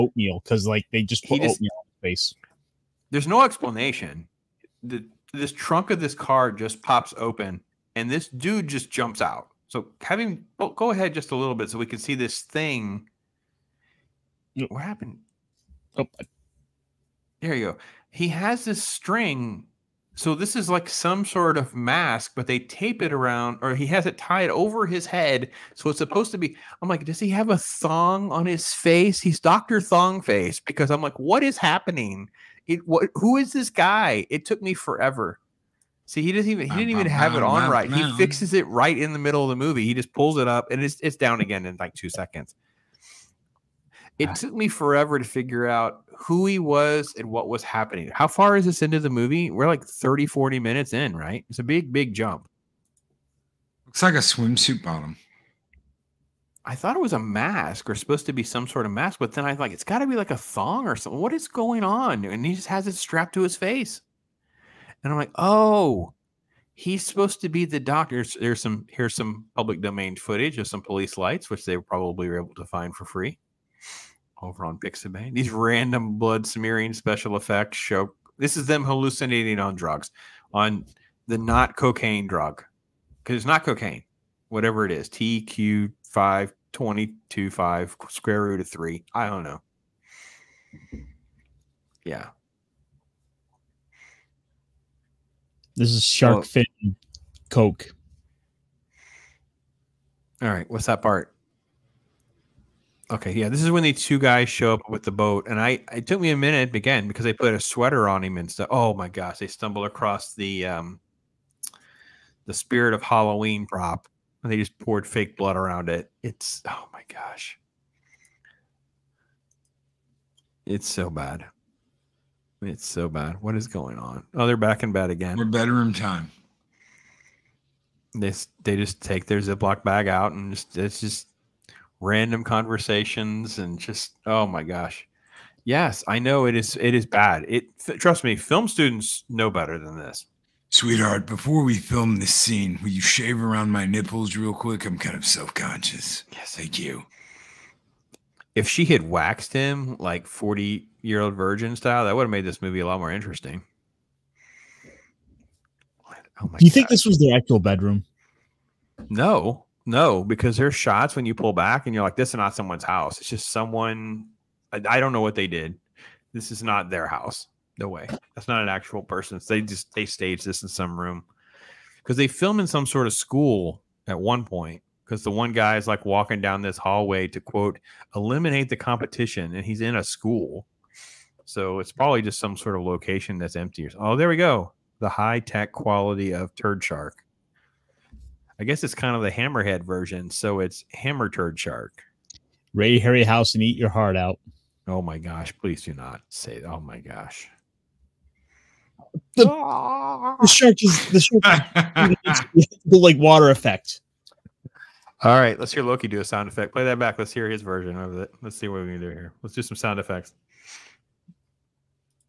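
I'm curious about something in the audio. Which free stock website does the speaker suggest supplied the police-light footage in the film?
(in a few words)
Pixabay.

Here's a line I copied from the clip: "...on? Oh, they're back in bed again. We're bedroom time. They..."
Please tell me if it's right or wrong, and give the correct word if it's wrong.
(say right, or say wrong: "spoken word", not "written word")
right.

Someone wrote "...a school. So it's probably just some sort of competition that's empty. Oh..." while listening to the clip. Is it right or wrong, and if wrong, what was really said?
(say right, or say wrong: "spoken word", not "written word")
wrong: "location", not "competition".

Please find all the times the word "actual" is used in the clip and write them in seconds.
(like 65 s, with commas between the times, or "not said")
157 s, 168 s.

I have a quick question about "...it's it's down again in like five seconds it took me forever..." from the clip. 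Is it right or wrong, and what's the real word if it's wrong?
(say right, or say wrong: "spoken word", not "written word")
wrong: "two", not "five".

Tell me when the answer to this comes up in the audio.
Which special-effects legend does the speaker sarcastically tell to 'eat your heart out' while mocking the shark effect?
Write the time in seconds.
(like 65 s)
192 s.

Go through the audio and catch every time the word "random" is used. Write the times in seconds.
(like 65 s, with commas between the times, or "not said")
75 s, 131 s.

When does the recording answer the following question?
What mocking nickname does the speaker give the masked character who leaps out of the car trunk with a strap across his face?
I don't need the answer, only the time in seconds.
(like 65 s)
29 s.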